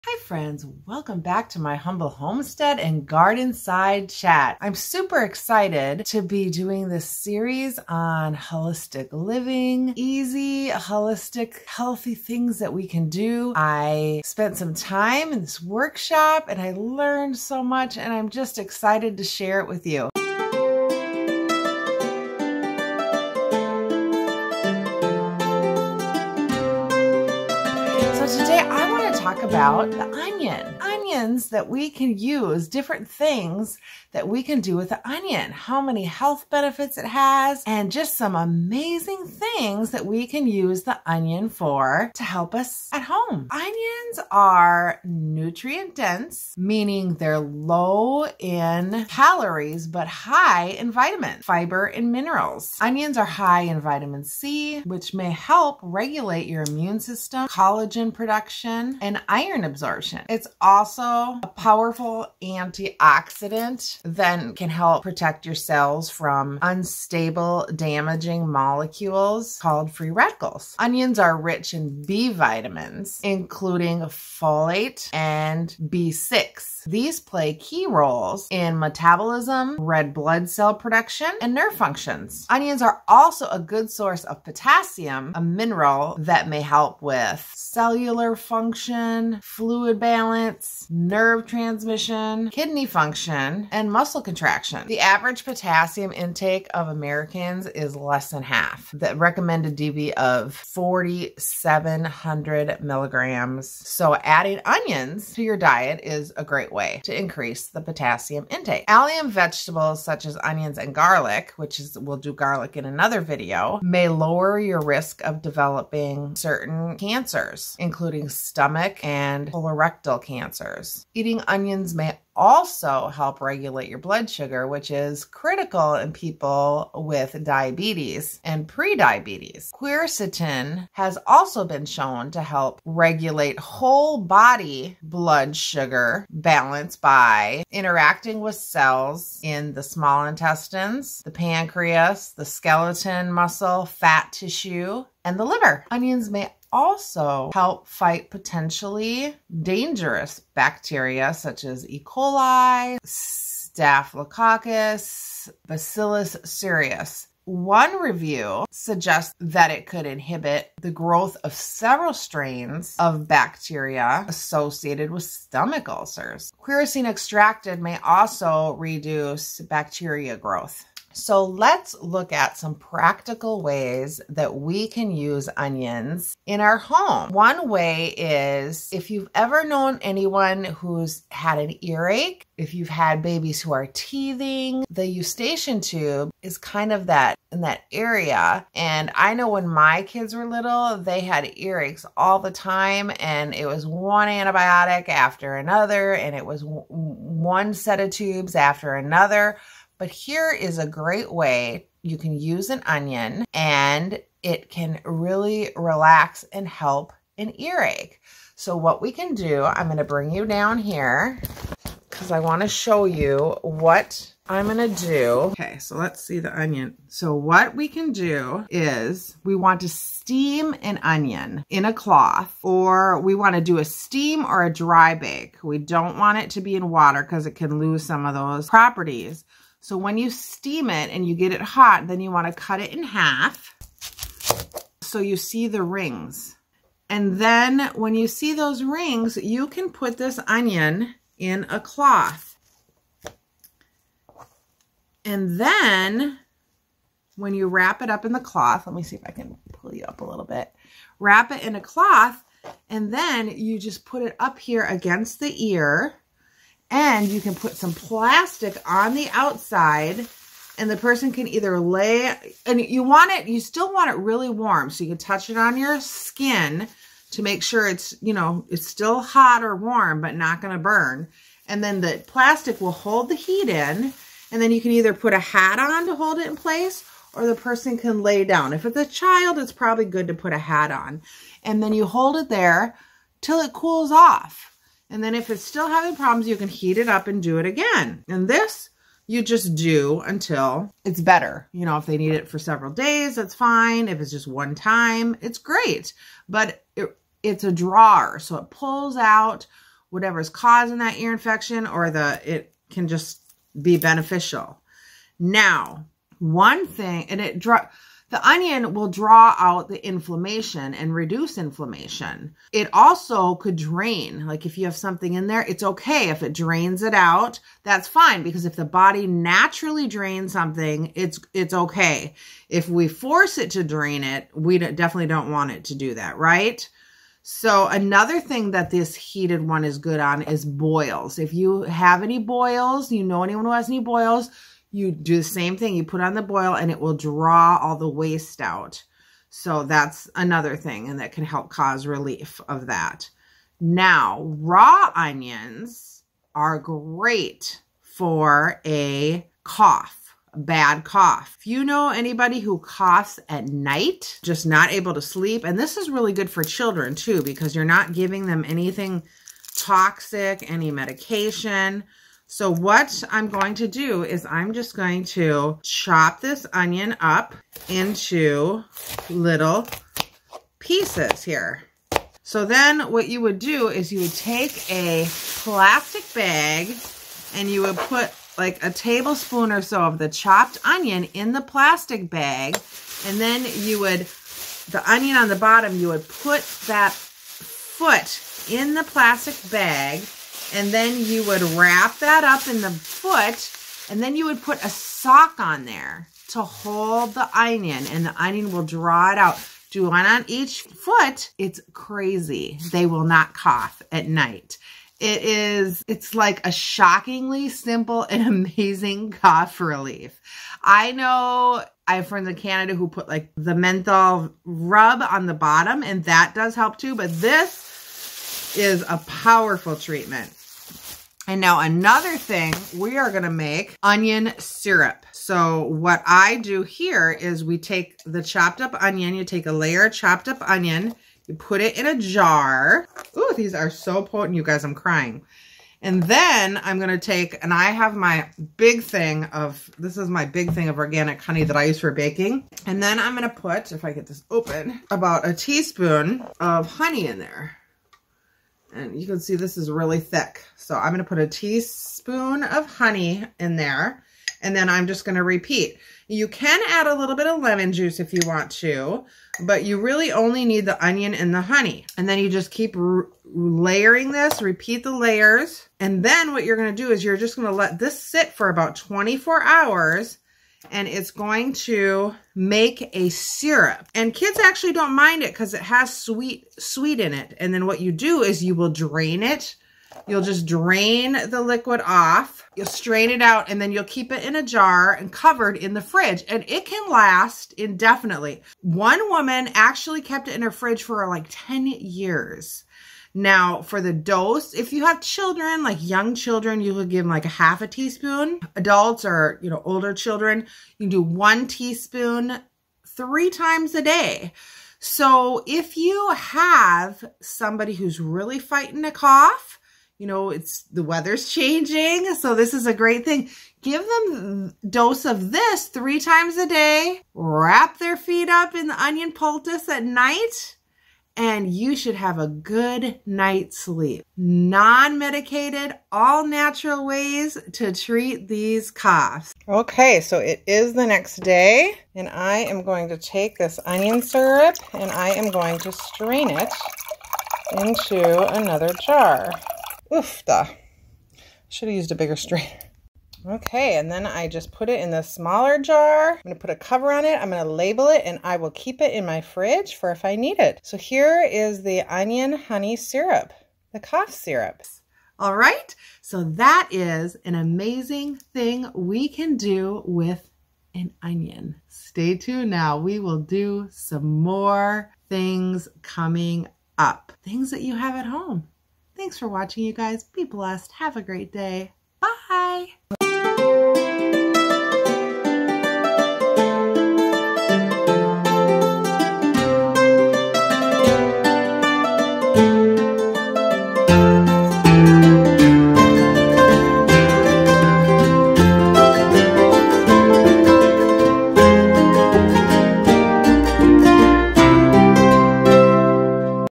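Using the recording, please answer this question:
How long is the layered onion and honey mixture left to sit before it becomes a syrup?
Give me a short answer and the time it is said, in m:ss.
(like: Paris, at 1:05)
24 hours, at 7:48.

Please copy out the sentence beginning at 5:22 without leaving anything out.
If we force it to drain it, we definitely don't want it to do that, right?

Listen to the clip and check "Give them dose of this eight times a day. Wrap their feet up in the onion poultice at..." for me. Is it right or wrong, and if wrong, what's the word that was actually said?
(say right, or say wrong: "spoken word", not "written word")
wrong: "three", not "eight".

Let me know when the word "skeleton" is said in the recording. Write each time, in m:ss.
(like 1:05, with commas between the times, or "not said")
2:22.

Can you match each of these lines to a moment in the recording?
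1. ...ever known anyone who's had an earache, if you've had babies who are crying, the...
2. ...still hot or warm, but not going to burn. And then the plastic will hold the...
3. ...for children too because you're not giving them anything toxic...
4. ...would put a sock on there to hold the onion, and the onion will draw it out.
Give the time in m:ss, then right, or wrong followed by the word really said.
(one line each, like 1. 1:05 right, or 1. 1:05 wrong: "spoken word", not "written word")
1. 2:59 wrong: "teething", not "crying"
2. 4:28 right
3. 5:56 right
4. 6:34 right.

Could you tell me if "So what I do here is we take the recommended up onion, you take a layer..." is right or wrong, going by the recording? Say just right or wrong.
wrong.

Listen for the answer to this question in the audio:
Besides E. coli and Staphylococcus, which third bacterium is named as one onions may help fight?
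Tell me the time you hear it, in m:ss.
2:35.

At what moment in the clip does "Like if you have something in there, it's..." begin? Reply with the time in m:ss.
5:14.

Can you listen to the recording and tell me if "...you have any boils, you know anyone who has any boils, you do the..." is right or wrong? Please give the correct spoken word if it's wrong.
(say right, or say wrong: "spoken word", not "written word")
right.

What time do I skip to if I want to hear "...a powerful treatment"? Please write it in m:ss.
6:59.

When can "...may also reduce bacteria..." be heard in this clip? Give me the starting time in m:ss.
2:47.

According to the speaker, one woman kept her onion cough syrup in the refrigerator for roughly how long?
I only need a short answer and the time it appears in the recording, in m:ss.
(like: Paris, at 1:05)
10 years, at 8:11.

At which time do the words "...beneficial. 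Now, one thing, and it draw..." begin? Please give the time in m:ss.
5:03.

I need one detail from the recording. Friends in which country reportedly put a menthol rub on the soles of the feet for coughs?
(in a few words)
Canada.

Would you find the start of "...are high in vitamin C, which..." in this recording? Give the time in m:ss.
0:53.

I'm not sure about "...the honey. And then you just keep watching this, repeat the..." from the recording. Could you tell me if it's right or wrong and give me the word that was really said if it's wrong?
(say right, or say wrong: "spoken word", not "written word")
wrong: "layering", not "watching".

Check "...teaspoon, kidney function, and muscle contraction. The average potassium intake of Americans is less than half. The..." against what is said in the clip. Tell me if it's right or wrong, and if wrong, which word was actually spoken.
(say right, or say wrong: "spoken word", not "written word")
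wrong: "transmission", not "teaspoon".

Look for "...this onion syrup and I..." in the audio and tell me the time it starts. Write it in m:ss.
8:53.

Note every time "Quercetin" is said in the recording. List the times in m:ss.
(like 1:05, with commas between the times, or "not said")
2:09, 2:46.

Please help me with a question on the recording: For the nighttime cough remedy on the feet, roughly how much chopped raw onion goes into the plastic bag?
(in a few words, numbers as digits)
a tablespoon.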